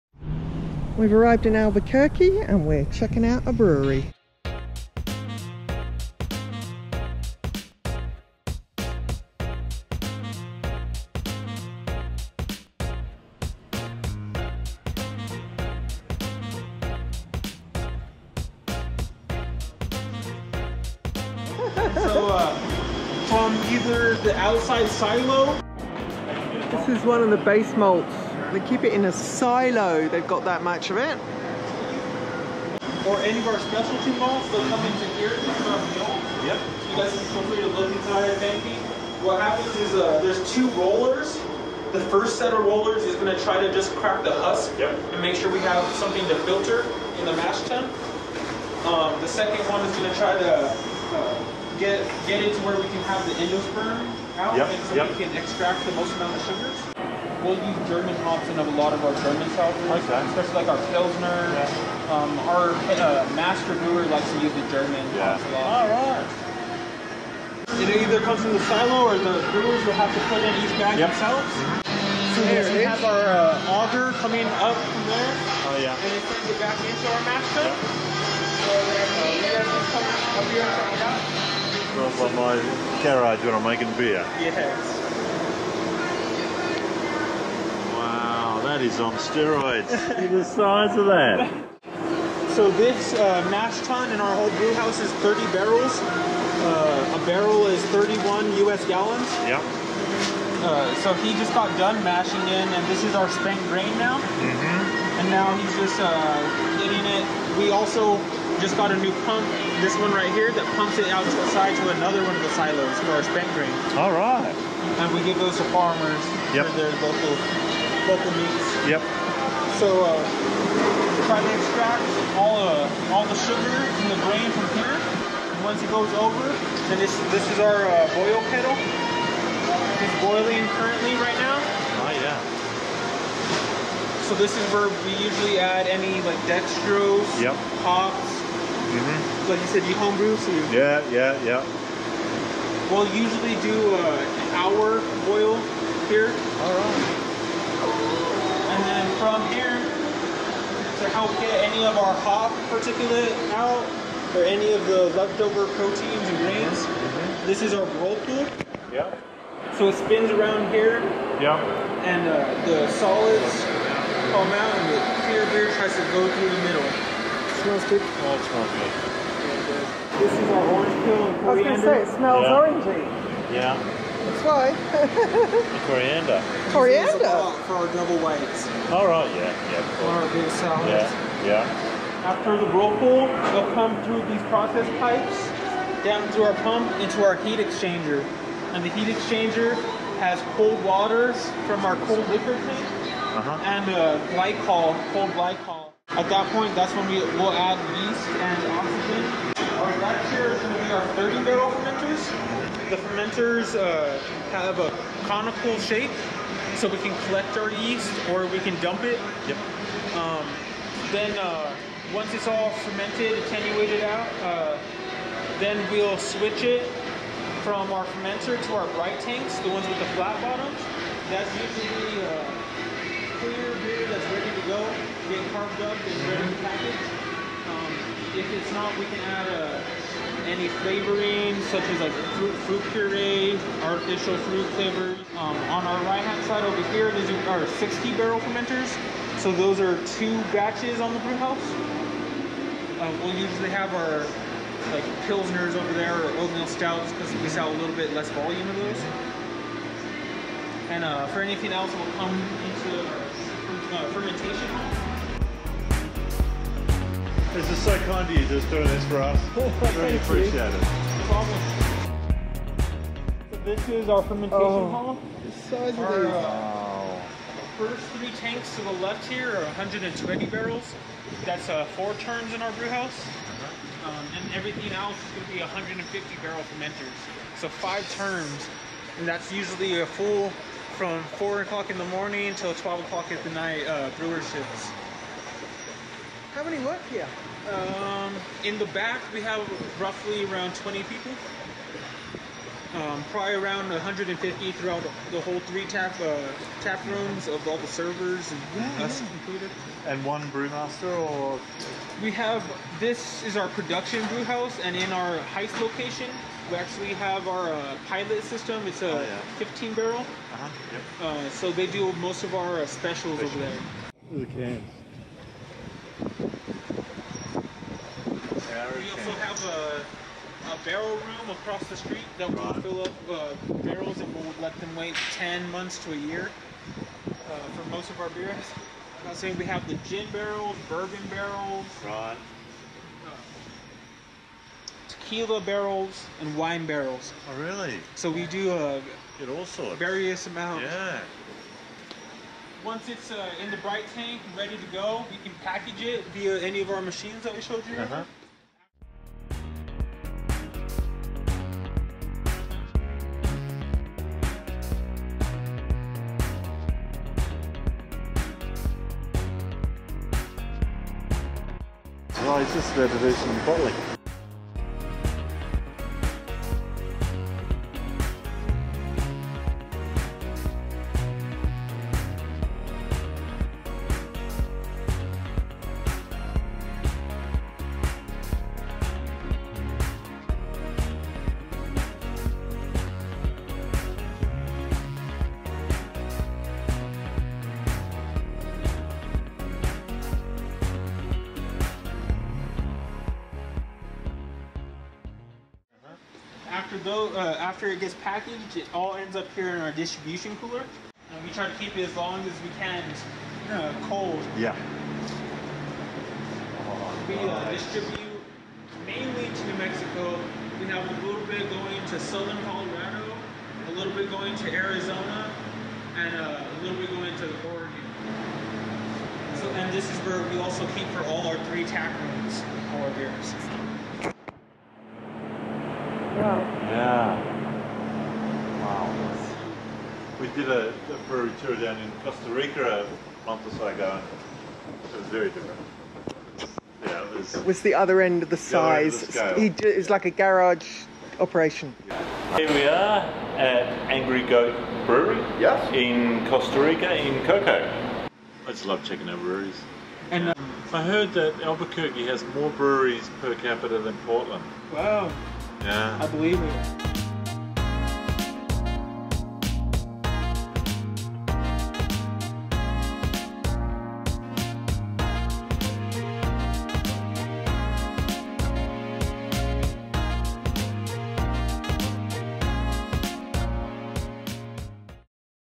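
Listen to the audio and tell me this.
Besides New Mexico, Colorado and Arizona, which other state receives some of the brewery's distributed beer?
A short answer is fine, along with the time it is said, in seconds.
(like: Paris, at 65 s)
Oregon, at 417 s.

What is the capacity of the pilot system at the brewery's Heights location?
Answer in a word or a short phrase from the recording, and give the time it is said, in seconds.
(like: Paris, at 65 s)
15 barrels, at 309 s.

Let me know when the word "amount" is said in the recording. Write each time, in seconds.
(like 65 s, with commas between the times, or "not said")
56 s, 340 s.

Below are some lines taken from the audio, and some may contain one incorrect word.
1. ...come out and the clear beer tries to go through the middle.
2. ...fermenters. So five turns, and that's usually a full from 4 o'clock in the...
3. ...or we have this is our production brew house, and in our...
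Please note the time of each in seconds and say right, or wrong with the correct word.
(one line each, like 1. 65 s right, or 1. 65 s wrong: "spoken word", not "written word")
1. 164 s right
2. 276 s right
3. 301 s right.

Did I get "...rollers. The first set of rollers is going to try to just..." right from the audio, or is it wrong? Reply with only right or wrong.
right.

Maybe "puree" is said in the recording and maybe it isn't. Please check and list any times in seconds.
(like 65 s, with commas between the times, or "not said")
232 s.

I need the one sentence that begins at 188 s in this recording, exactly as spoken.
And the heat exchanger has cold waters from our cold liquor tank uh -huh.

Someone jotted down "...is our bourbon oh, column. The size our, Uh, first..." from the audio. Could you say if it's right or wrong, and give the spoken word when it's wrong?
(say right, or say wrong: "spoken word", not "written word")
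wrong: "fermentation", not "bourbon".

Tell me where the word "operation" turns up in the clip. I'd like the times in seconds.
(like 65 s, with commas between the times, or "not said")
441 s.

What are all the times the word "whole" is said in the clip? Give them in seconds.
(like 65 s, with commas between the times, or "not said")
94 s, 295 s.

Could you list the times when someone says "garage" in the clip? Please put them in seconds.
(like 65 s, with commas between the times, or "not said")
83 s, 440 s.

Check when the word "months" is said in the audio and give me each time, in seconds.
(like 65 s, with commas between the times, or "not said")
325 s, 433 s.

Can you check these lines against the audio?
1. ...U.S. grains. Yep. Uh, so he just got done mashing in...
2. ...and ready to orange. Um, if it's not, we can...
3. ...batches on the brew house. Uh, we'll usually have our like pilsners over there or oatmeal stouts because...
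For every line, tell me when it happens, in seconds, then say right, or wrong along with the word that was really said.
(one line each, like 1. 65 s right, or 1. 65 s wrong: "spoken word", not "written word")
1. 98 s wrong: "gallons", not "grains"
2. 225 s wrong: "package", not "orange"
3. 240 s right.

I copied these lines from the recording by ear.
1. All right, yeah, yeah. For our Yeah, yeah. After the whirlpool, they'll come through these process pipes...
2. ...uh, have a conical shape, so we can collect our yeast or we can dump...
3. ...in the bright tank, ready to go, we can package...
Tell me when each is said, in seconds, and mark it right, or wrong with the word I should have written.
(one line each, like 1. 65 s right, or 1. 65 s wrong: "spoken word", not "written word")
1. 178 s right
2. 203 s right
3. 343 s right.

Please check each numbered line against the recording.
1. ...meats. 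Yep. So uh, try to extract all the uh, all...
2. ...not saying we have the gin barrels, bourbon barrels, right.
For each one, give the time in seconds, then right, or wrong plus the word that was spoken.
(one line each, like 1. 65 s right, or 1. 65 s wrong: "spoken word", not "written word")
1. 118 s right
2. 329 s right.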